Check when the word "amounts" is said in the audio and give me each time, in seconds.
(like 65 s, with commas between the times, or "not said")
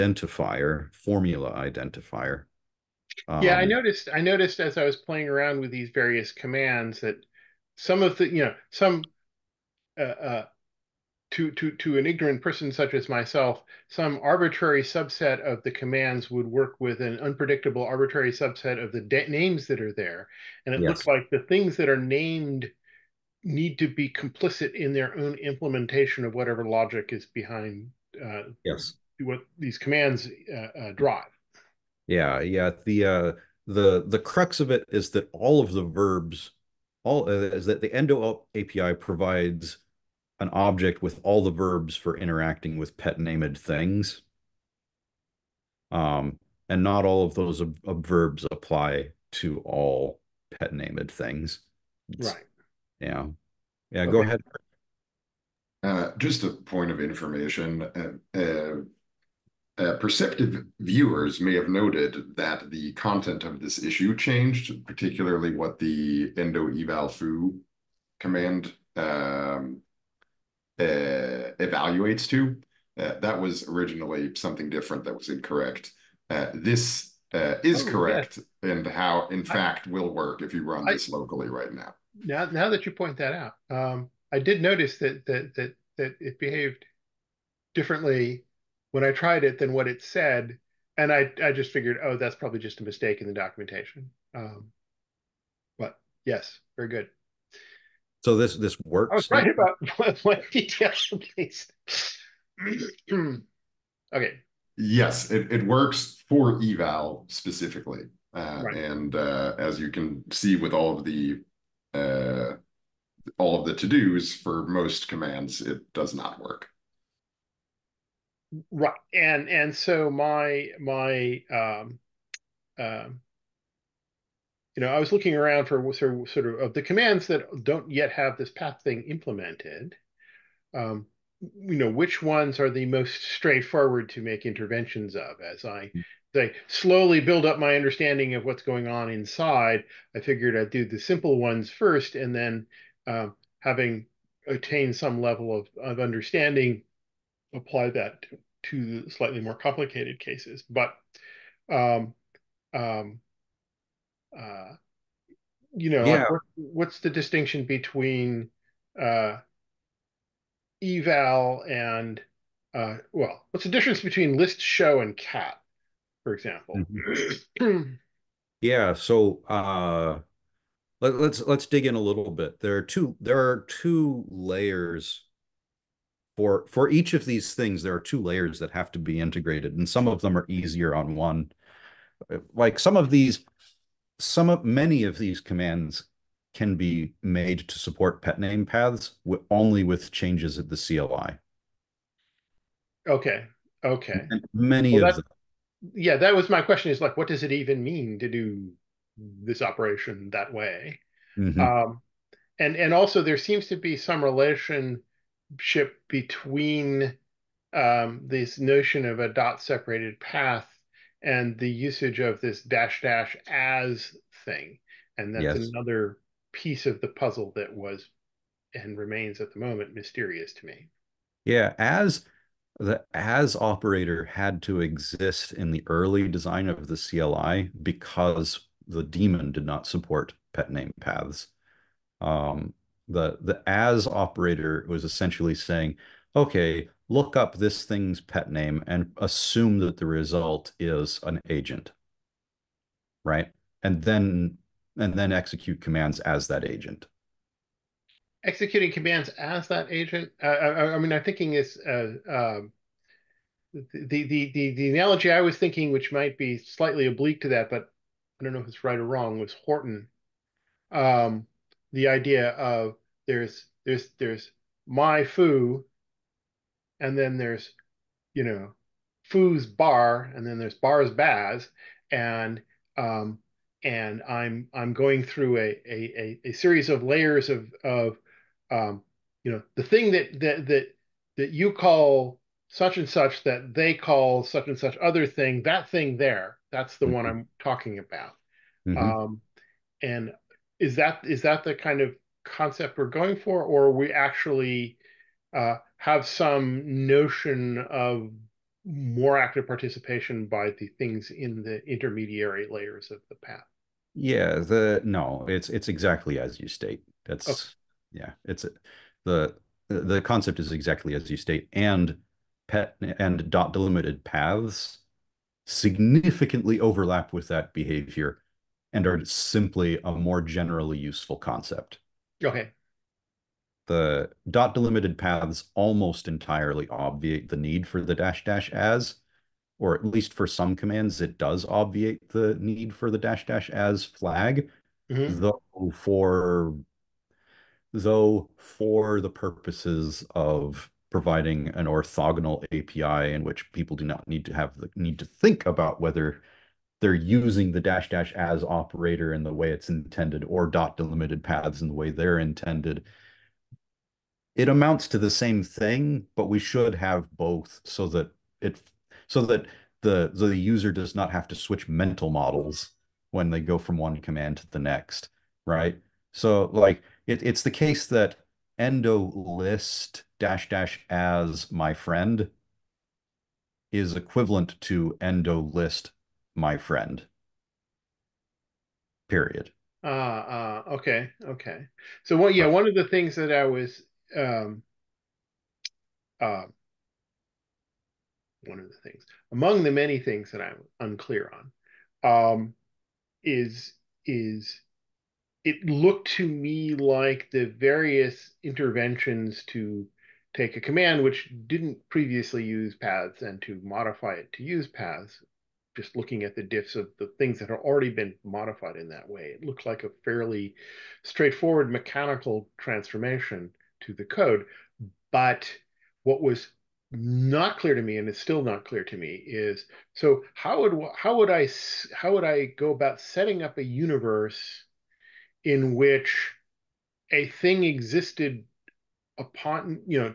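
354 s.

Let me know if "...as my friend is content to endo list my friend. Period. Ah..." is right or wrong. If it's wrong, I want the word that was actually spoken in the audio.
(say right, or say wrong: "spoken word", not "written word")
wrong: "equivalent", not "content".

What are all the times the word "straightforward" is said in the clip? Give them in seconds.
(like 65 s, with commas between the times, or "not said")
133 s, 411 s.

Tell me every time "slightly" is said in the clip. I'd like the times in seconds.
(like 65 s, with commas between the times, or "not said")
149 s, 256 s.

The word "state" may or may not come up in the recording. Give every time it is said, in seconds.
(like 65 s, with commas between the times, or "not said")
306 s, 311 s.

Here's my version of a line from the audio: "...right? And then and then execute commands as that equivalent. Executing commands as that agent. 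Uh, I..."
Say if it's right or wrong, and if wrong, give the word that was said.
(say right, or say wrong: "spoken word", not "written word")
wrong: "agent", not "equivalent".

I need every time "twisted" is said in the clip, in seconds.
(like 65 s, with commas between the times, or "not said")
not said.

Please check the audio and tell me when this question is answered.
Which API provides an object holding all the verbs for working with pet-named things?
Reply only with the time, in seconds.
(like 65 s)
37 s.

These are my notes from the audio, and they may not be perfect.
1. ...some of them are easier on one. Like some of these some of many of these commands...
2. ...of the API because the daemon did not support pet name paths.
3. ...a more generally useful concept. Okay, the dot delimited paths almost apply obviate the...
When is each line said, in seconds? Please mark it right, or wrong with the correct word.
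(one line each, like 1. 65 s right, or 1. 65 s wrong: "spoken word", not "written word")
1. 179 s right
2. 226 s wrong: "CLI", not "API"
3. 320 s wrong: "entirely", not "apply".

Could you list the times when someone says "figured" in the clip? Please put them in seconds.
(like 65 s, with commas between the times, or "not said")
91 s, 140 s.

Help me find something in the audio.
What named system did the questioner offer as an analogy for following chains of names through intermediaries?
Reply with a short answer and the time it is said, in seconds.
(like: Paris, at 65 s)
Horton, at 259 s.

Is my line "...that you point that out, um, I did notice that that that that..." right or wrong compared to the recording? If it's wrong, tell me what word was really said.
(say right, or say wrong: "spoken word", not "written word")
right.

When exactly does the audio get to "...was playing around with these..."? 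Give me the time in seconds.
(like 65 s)
4 s.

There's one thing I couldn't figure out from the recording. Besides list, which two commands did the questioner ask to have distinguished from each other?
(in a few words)
show and cat.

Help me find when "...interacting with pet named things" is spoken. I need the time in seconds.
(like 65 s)
42 s.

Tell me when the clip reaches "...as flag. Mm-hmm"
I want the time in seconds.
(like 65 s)
333 s.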